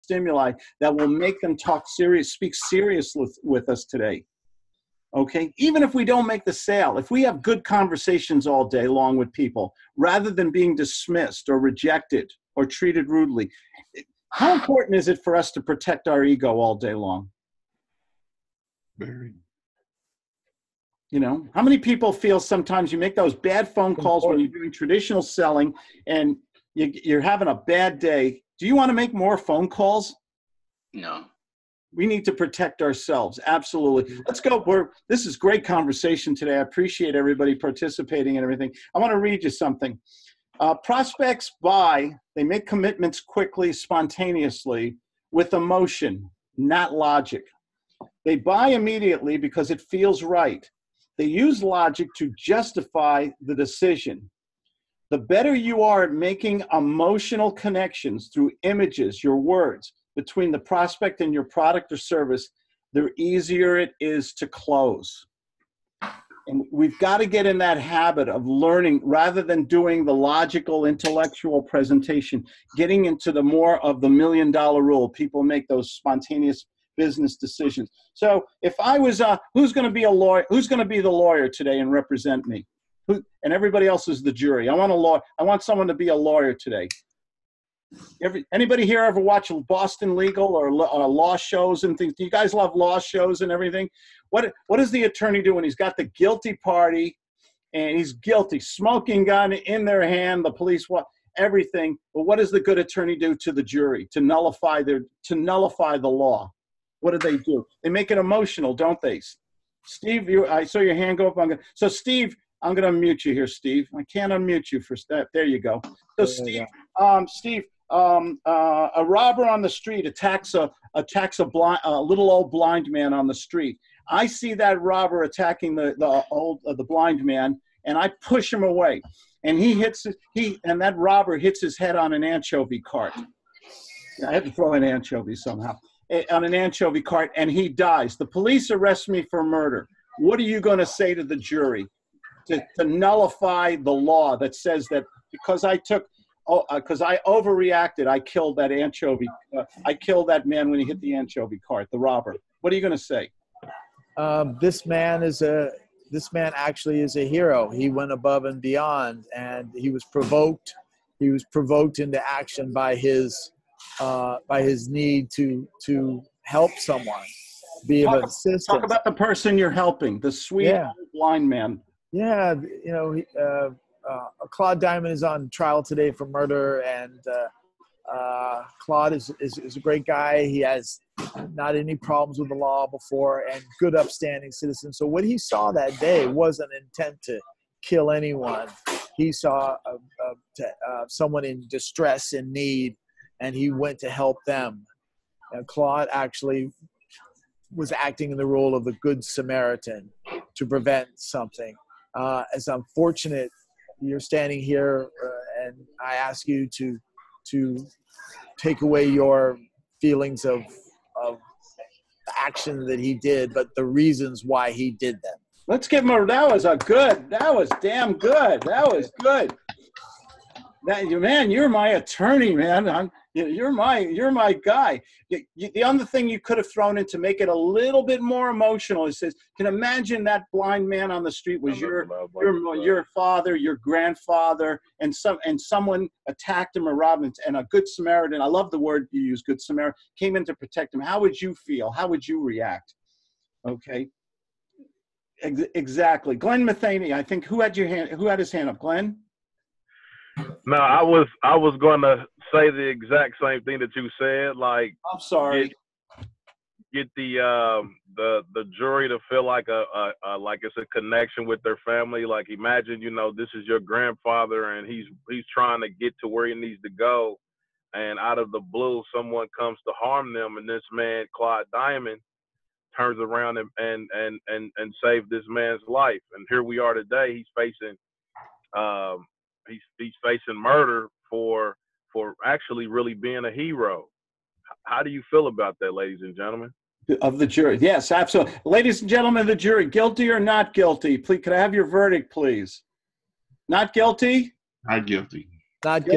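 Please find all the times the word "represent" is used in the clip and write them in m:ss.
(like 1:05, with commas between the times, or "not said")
1:21.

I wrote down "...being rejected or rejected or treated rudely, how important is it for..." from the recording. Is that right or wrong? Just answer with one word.
wrong.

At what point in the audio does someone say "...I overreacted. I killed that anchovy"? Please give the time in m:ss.
2:27.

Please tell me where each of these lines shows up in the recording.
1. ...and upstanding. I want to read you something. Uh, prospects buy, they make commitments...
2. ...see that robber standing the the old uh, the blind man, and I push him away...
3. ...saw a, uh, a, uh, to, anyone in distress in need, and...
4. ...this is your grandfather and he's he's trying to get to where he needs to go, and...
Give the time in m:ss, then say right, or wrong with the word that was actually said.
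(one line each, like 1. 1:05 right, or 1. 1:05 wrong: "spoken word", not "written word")
1. 0:38 wrong: "everything", not "upstanding"
2. 2:04 wrong: "attacking", not "standing"
3. 3:09 wrong: "someone", not "anyone"
4. 4:23 right.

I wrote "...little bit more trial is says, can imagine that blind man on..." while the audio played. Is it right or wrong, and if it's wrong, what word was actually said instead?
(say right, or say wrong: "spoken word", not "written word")
wrong: "emotional", not "trial".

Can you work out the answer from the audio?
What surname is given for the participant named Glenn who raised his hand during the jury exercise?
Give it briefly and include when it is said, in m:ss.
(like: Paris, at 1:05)
Matheny, at 4:06.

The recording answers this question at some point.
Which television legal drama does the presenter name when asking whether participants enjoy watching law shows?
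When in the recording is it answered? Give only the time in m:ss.
1:29.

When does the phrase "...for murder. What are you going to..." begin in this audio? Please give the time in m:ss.
2:19.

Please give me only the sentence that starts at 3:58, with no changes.
I love the word you use, good Samaritan, came in to protect him.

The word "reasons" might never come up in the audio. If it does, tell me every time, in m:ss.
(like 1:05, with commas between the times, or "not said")
3:33.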